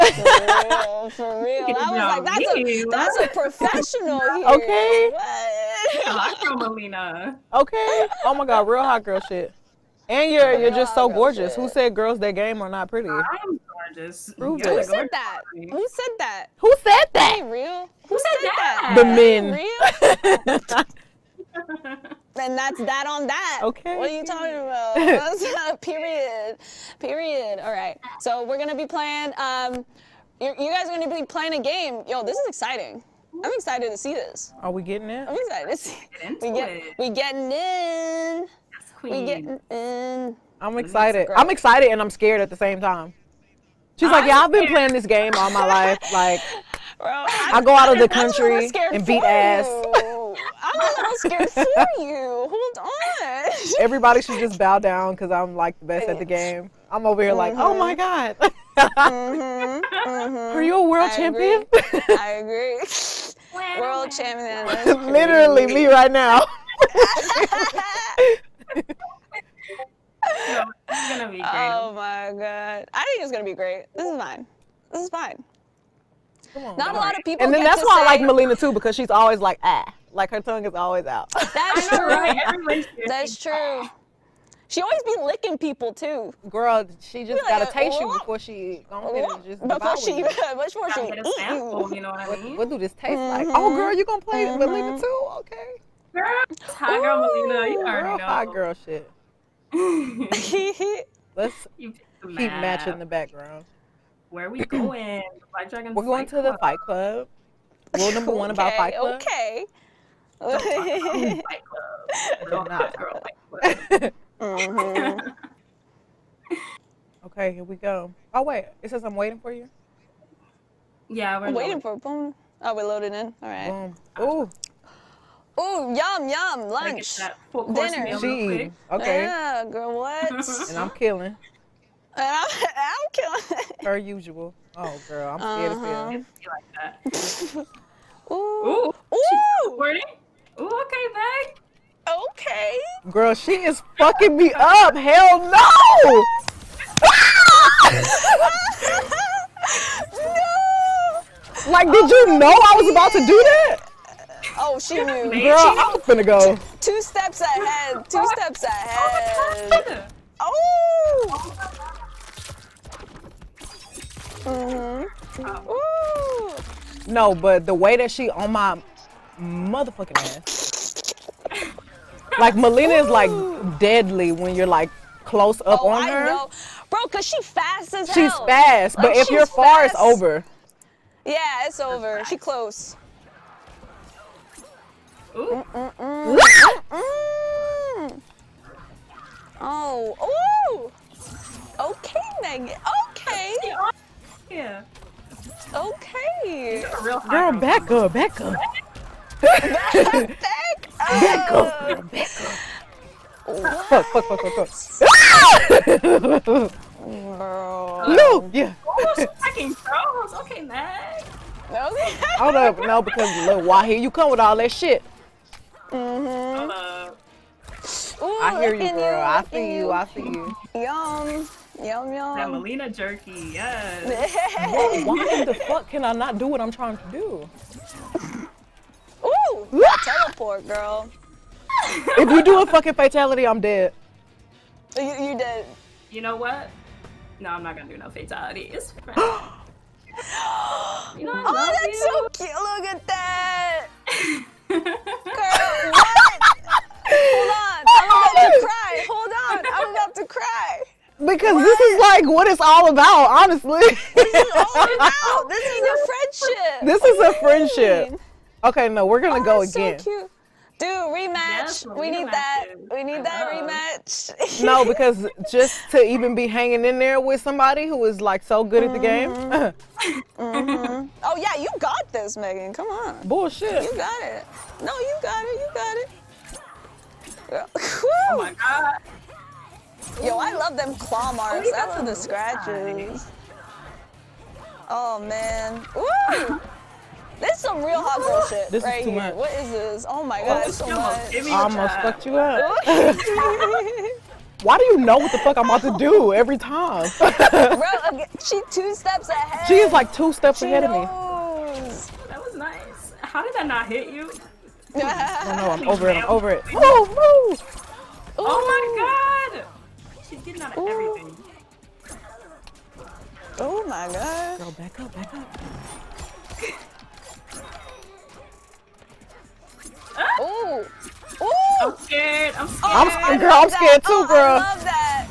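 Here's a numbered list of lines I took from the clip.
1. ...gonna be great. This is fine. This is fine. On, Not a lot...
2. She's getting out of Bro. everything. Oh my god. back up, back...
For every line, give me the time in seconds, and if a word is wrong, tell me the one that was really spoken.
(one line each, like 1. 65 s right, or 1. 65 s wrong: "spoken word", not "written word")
1. 73 s right
2. 310 s wrong: "Ooh", not "Bro".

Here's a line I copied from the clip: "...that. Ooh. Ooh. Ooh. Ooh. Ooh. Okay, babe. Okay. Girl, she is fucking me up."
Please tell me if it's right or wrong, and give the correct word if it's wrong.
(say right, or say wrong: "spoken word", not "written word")
right.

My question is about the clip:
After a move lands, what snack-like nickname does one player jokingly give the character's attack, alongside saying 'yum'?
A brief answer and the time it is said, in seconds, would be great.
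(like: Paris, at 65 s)
Mileena jerky, at 222 s.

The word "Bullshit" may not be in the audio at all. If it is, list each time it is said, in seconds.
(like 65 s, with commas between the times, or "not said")
273 s.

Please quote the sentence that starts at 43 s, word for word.
She's I'm like, yeah, I've been playing this game all my life.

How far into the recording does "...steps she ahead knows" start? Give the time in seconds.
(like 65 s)
300 s.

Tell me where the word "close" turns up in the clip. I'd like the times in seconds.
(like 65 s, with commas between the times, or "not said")
175 s, 182 s.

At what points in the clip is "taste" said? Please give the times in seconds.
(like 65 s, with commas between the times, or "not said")
87 s, 92 s.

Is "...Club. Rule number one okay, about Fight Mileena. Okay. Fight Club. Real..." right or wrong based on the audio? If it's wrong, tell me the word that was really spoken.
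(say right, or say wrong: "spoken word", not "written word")
wrong: "Club", not "Mileena".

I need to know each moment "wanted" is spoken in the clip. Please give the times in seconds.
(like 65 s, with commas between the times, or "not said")
not said.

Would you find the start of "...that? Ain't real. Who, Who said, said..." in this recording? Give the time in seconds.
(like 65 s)
17 s.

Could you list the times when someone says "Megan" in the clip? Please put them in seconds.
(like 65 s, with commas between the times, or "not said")
192 s, 272 s.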